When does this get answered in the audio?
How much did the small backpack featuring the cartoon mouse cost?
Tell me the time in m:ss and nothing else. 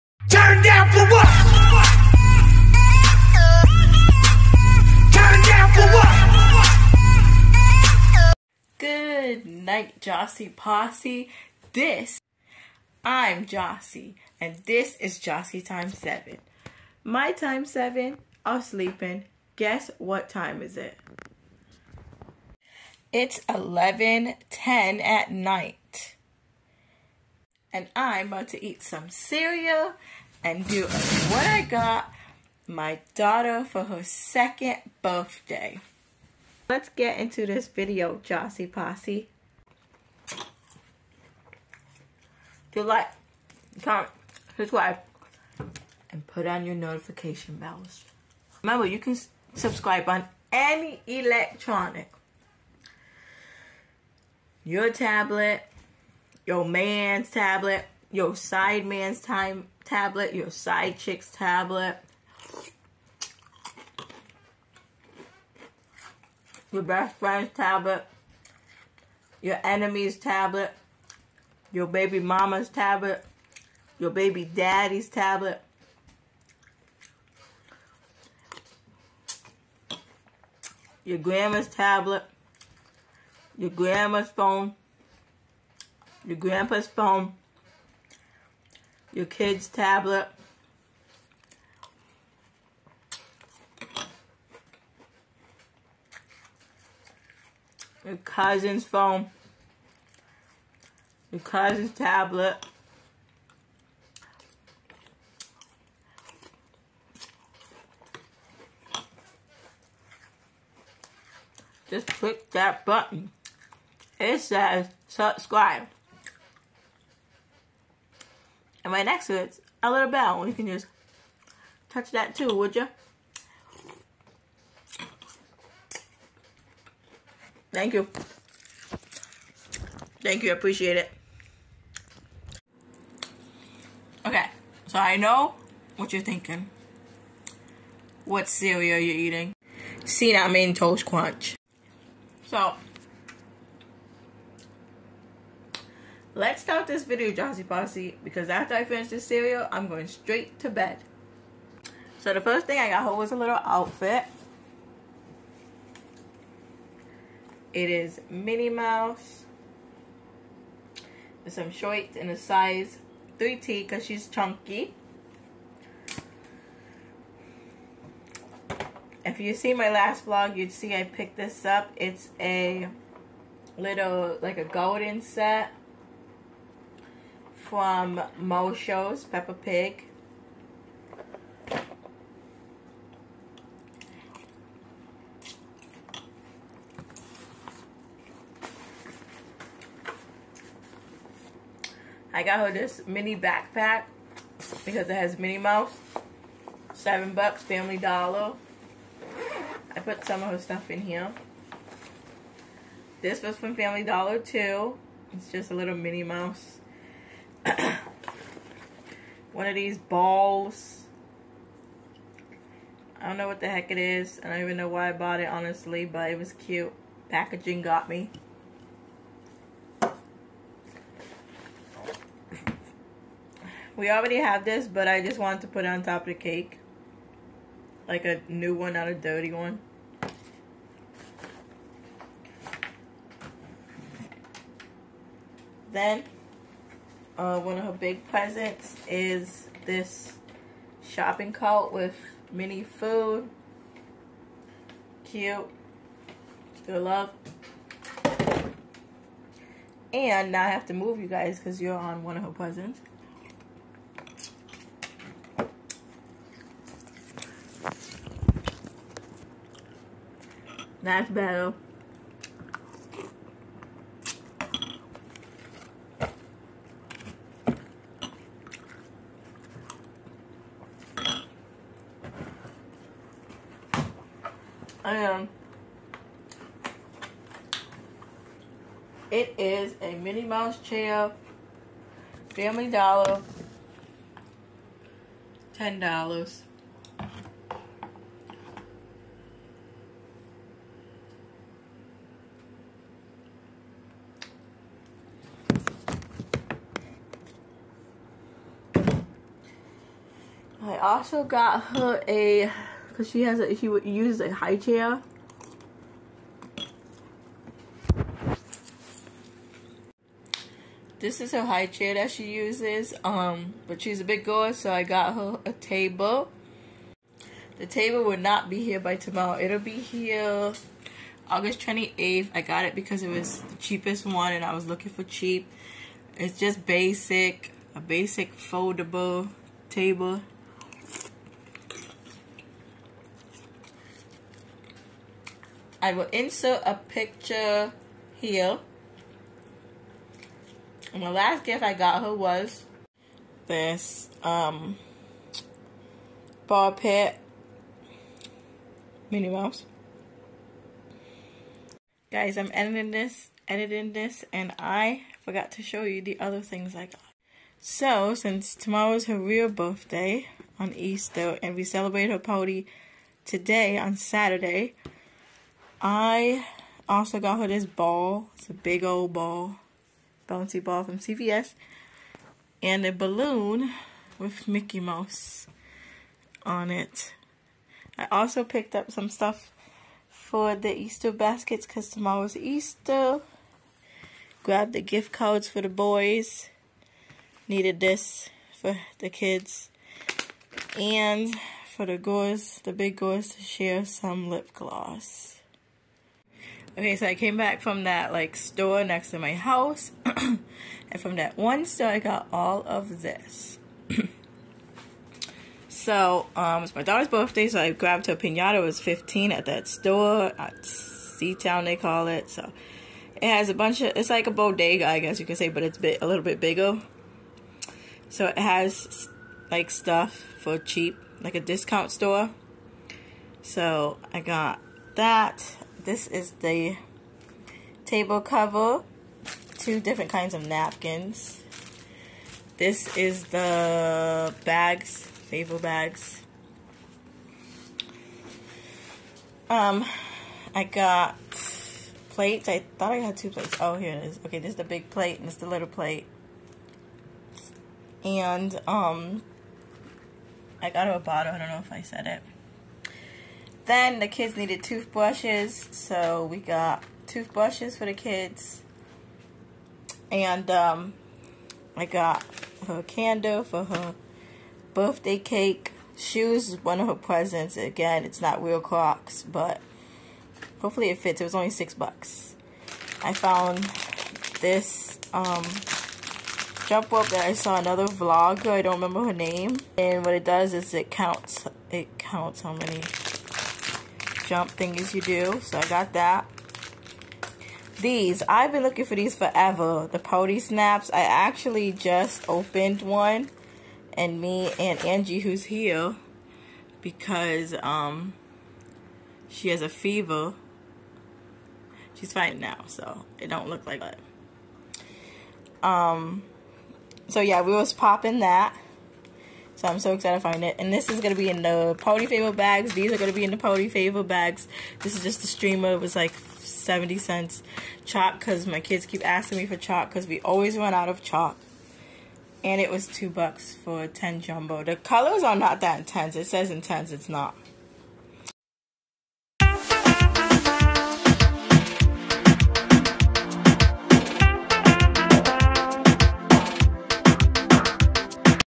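3:16.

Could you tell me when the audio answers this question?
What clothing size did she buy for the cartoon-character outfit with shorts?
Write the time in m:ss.
2:43.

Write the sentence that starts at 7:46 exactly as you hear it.
Shoes is one of her presents.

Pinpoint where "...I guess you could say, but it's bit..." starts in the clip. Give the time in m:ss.
6:55.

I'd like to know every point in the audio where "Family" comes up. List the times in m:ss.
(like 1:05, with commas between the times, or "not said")
3:17, 3:23, 4:42.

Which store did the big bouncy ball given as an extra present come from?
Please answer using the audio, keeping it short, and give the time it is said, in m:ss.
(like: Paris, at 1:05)
CVS, at 6:11.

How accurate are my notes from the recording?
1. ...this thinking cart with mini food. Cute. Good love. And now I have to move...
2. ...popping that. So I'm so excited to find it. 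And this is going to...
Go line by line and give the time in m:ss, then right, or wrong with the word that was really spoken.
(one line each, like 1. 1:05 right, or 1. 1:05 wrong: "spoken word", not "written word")
1. 3:59 wrong: "shopping", not "thinking"
2. 8:27 right.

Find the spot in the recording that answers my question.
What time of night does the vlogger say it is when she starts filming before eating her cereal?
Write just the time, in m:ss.
0:23.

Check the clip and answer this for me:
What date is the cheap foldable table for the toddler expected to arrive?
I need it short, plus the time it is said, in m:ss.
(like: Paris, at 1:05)
August 28th, at 5:21.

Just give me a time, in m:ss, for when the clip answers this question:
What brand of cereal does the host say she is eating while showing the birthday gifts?
2:20.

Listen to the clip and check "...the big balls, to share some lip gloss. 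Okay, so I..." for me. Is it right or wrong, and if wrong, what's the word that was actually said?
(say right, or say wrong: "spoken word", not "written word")
wrong: "girls", not "balls".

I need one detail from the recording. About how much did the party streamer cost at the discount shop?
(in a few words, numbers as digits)
70 cents.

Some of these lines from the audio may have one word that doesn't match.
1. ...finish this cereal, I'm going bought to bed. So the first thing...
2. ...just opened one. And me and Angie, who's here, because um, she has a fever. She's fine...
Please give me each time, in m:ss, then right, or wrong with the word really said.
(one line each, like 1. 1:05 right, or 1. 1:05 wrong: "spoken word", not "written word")
1. 2:28 wrong: "straight", not "bought"
2. 8:11 right.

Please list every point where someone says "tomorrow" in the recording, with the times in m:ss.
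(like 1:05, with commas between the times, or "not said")
5:19, 5:58, 6:22.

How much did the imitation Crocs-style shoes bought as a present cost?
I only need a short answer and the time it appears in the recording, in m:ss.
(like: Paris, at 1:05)
$6, at 7:51.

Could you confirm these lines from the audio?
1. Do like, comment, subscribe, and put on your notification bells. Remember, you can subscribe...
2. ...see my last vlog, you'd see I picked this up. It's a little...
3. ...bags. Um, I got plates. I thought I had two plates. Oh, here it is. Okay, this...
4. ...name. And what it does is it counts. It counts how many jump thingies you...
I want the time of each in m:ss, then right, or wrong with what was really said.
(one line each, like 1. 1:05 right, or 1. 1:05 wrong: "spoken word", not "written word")
1. 0:42 right
2. 2:49 right
3. 7:15 right
4. 7:59 right.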